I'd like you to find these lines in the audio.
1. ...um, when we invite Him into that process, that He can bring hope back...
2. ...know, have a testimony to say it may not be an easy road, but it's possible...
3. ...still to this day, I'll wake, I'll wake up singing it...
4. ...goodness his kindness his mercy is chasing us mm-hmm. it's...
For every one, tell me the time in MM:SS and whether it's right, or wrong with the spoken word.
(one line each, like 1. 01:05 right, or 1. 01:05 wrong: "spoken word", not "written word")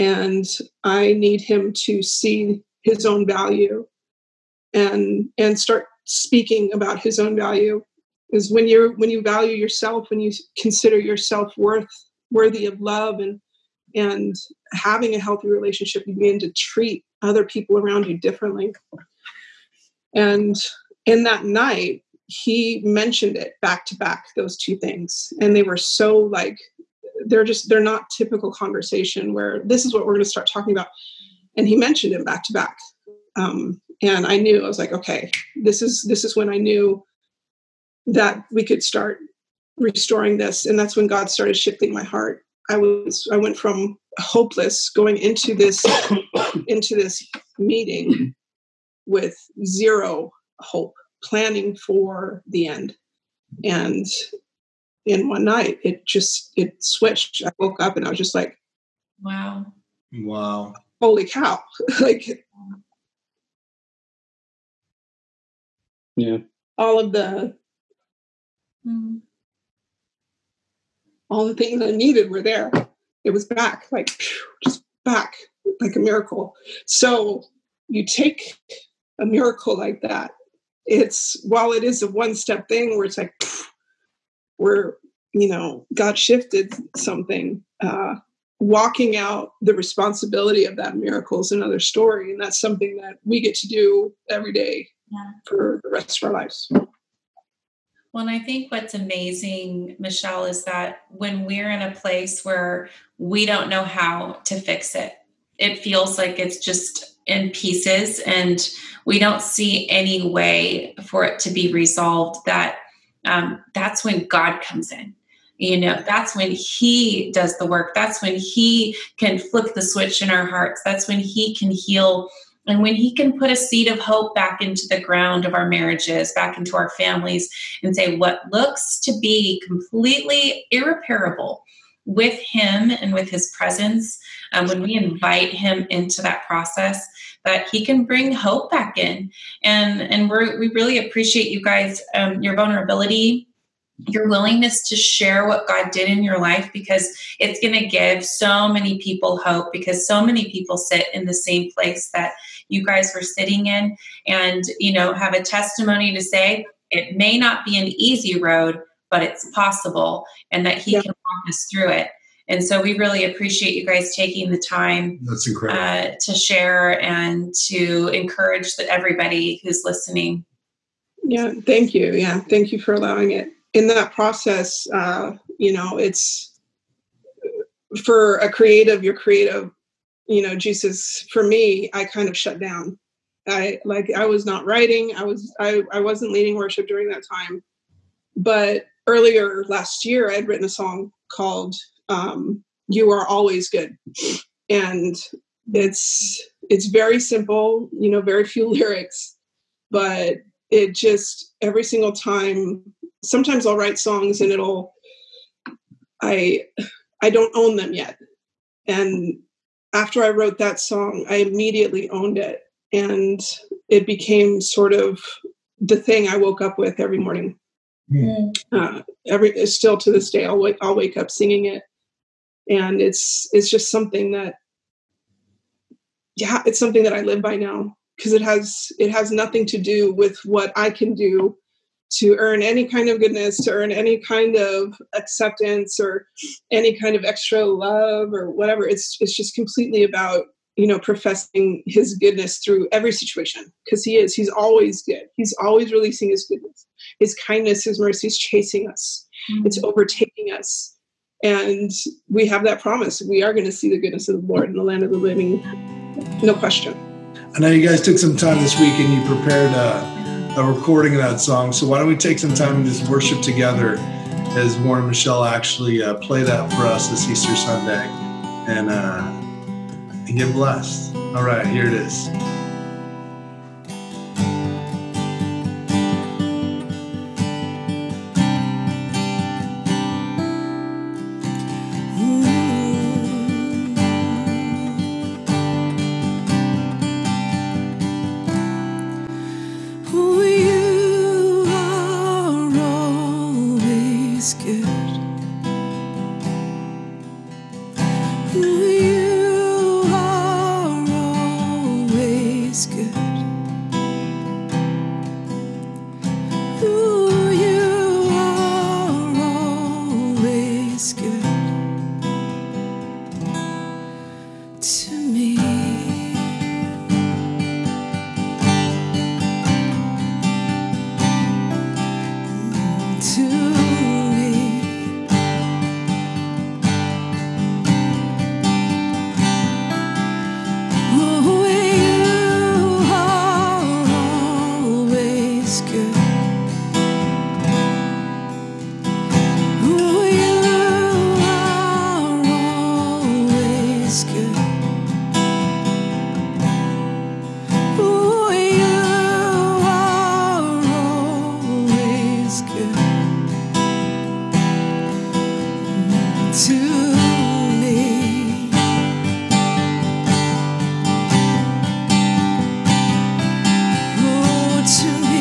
1. 02:14 right
2. 02:34 right
3. 03:39 right
4. 04:06 right.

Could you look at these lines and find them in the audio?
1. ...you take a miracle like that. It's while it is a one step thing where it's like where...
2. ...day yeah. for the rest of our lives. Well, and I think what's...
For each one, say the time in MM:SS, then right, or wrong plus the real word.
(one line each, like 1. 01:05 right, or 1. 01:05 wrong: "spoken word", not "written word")
1. 01:17 right
2. 01:34 right.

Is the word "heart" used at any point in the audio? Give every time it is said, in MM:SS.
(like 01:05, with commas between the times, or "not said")
00:42, 02:00.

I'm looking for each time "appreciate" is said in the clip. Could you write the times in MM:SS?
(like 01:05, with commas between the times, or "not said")
02:20, 02:43.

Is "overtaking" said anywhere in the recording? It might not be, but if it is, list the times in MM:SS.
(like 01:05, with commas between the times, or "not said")
04:09.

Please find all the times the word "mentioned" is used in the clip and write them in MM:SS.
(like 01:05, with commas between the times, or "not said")
00:22, 00:31.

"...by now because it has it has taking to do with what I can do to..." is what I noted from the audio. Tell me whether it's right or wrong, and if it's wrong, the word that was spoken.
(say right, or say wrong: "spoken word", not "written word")
wrong: "nothing", not "taking".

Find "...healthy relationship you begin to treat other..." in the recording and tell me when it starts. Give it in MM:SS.
00:15.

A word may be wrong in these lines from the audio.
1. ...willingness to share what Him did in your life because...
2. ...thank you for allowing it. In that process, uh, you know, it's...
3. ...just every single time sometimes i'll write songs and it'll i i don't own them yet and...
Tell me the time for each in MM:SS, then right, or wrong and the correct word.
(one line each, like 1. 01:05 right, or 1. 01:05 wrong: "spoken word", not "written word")
1. 02:24 wrong: "God", not "Him"
2. 02:52 right
3. 03:20 right.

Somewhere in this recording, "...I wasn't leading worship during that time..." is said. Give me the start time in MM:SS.
03:05.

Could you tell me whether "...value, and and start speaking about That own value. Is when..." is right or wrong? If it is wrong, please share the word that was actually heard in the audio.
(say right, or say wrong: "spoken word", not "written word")
wrong: "His", not "That".